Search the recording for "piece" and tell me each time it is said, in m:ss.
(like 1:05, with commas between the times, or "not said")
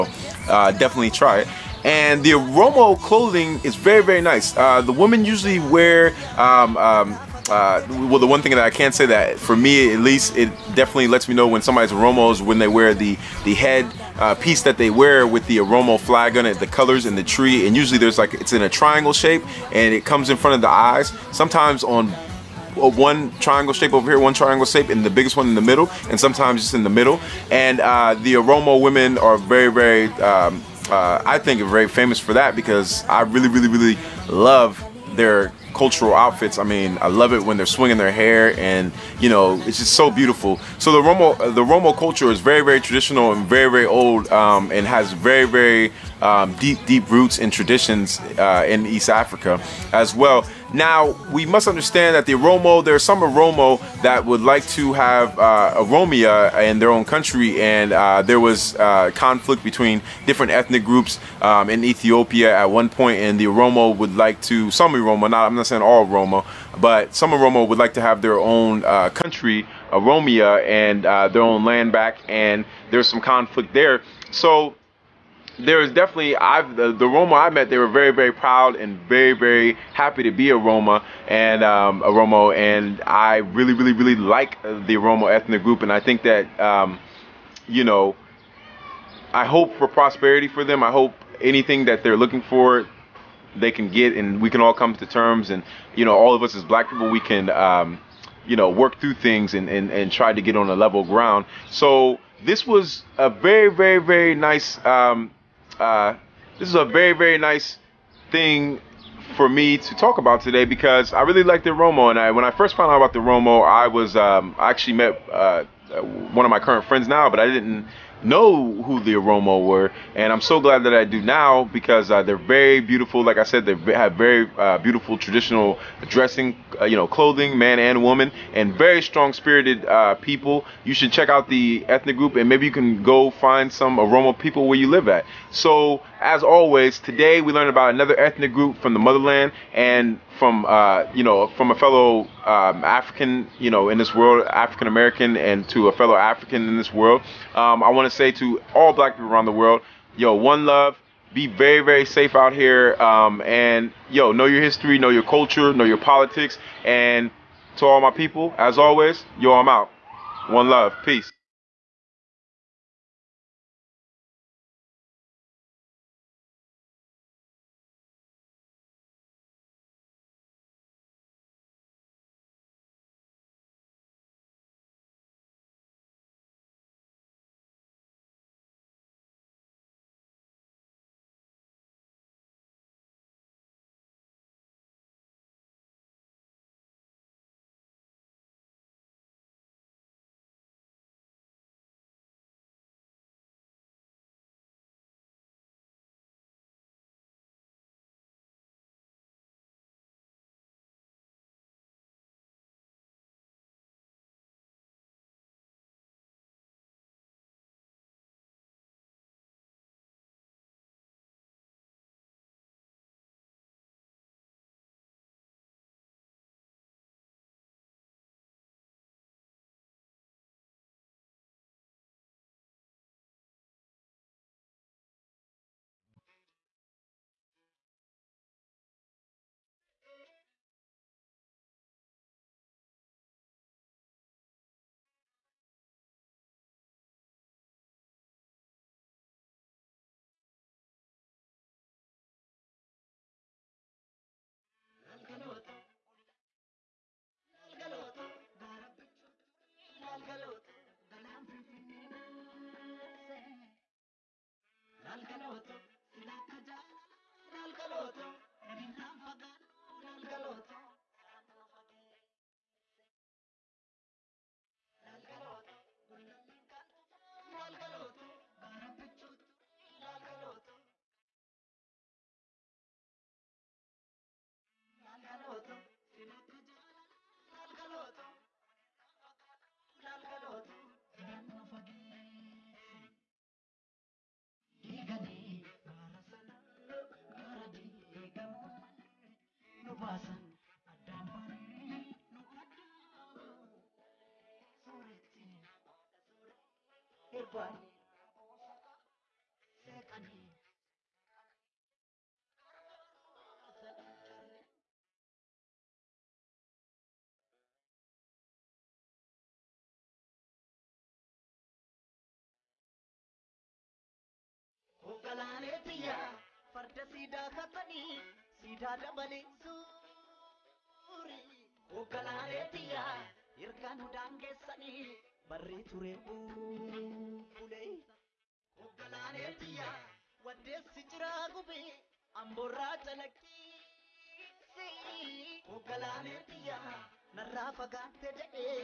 0:14.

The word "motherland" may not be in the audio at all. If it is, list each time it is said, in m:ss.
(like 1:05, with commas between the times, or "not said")
2:18.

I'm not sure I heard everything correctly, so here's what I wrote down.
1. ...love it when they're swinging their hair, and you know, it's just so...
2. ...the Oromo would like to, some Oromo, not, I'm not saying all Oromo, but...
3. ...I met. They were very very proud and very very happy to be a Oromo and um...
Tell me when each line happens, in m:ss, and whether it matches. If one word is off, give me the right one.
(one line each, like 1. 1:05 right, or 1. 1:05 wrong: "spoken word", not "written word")
1. 0:37 right
2. 1:03 right
3. 1:17 right.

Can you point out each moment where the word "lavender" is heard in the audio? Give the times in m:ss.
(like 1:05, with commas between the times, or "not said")
not said.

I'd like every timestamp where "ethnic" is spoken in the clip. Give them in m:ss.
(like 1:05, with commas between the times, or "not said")
1:00, 1:25, 2:11, 2:18.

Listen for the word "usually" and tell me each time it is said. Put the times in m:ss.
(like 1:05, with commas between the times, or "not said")
0:05, 0:17.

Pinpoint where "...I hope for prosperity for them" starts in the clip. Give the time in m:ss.
1:29.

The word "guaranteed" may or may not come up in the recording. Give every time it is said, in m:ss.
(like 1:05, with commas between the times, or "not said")
not said.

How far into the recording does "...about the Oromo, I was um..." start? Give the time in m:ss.
1:52.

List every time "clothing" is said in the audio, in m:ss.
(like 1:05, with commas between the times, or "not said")
0:02, 2:07.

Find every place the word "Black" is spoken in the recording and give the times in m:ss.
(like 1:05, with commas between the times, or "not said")
1:36, 2:28.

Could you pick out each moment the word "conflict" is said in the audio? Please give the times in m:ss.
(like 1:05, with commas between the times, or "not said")
0:59, 1:13.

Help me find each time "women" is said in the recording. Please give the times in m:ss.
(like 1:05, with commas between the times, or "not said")
0:04, 0:28.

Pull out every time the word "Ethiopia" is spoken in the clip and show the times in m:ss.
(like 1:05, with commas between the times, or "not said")
1:01.